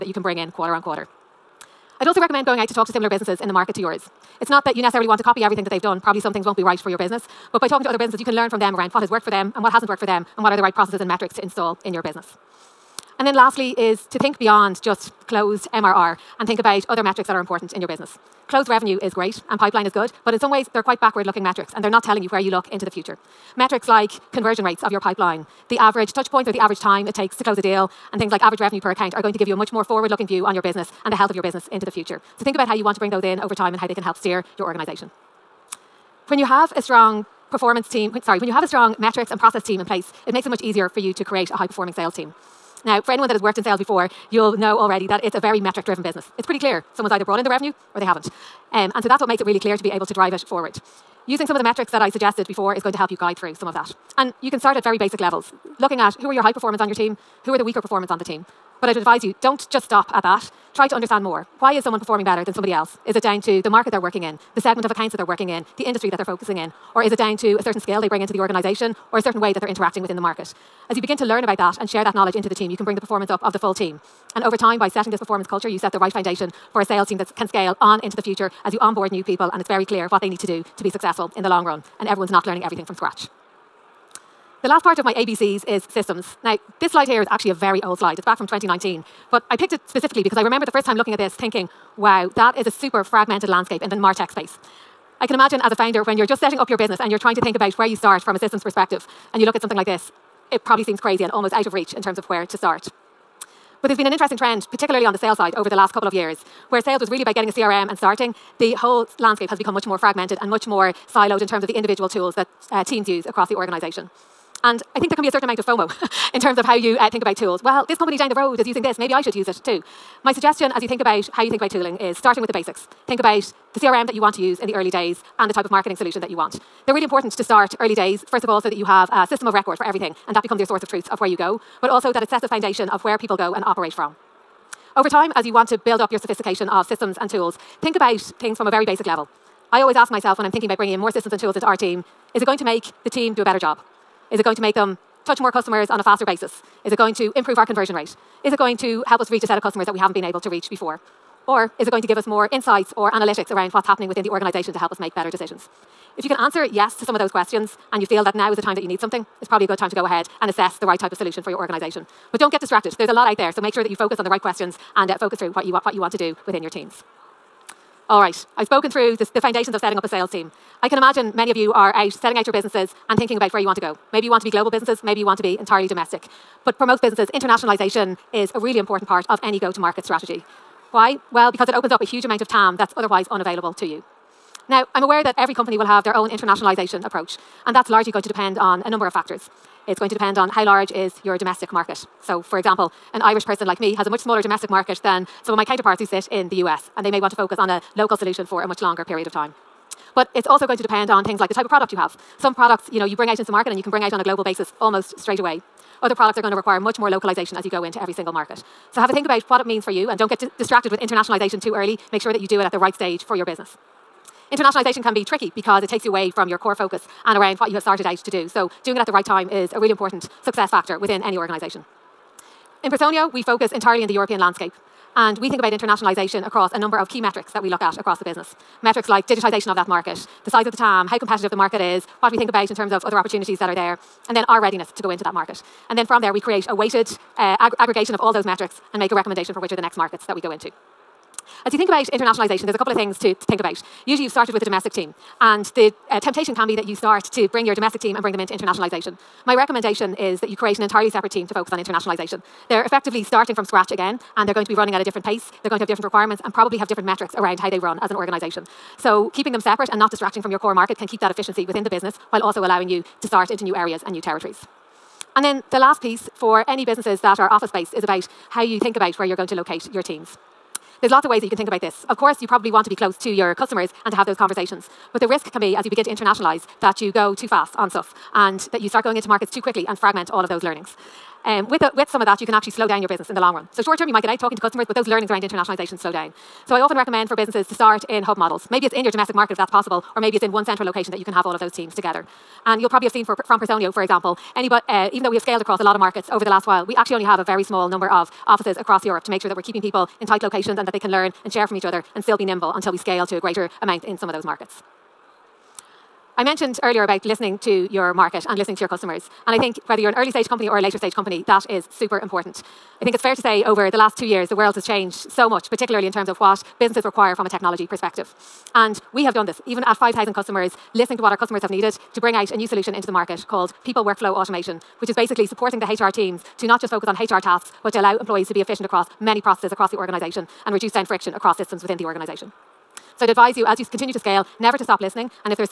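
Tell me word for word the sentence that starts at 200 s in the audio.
But it's also going to depend on things like the type of product you have.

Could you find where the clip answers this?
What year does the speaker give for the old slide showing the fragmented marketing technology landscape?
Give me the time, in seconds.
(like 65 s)
88 s.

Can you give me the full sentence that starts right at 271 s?
There's lots of ways that you can think about this.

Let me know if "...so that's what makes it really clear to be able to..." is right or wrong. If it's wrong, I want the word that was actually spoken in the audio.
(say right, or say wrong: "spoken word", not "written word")
right.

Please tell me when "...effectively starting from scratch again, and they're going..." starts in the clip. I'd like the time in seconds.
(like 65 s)
252 s.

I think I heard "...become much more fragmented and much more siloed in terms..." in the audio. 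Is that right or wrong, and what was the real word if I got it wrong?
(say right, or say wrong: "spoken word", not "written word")
right.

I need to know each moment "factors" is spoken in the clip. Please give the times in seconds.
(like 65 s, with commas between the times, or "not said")
189 s, 220 s.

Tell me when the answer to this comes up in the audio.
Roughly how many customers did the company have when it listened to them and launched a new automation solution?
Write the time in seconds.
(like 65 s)
319 s.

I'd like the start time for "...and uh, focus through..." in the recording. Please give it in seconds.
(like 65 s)
164 s.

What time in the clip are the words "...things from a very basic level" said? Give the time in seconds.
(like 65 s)
138 s.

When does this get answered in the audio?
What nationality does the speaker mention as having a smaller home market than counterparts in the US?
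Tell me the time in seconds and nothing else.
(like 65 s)
193 s.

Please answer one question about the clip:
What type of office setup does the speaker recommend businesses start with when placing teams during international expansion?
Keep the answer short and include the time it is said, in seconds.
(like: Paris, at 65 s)
Hub models, at 288 s.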